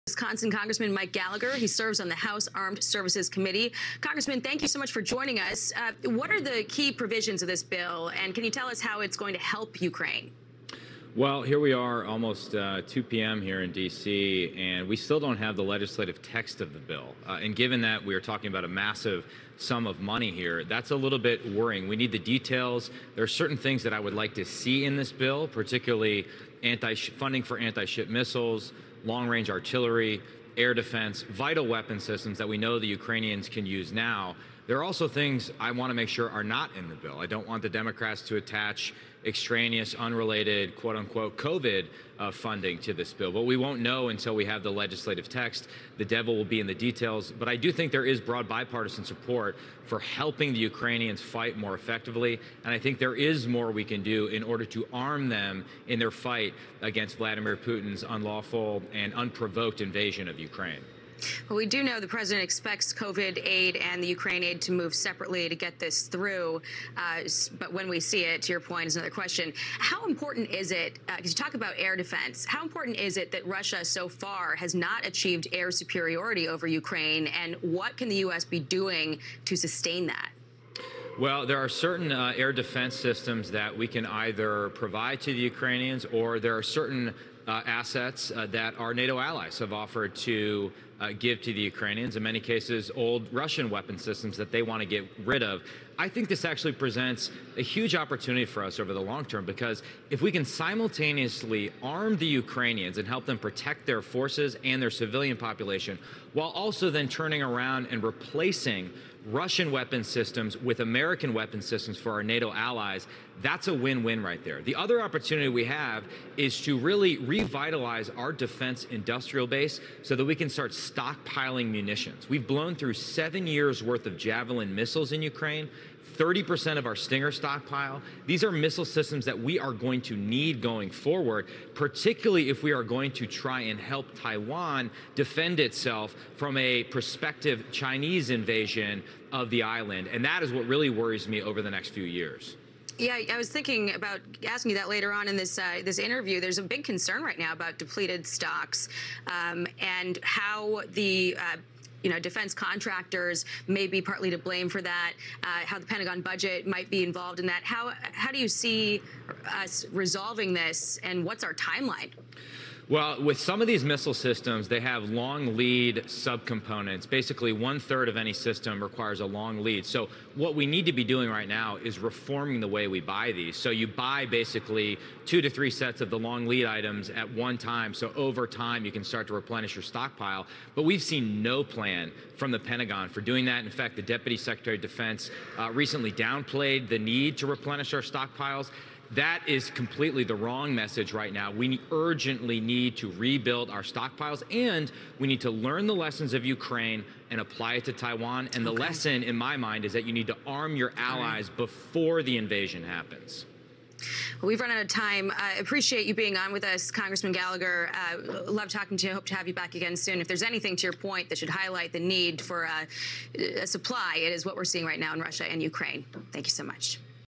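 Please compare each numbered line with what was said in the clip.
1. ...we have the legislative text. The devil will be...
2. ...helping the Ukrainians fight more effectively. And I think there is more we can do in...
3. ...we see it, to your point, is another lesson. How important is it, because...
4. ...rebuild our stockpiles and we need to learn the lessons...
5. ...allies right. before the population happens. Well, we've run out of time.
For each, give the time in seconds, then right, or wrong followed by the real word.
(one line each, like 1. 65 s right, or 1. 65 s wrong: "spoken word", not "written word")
1. 44 s right
2. 49 s right
3. 67 s wrong: "question", not "lesson"
4. 193 s right
5. 200 s wrong: "invasion", not "population".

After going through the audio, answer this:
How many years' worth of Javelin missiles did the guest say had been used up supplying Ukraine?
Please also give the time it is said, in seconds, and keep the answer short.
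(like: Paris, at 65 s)
7, at 122 s.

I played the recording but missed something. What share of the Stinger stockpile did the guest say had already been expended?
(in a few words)
30%.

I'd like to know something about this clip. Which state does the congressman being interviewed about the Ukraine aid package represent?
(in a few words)
Wisconsin.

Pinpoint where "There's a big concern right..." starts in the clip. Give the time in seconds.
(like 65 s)
146 s.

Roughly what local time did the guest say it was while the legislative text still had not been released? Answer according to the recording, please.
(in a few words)
2 p.m.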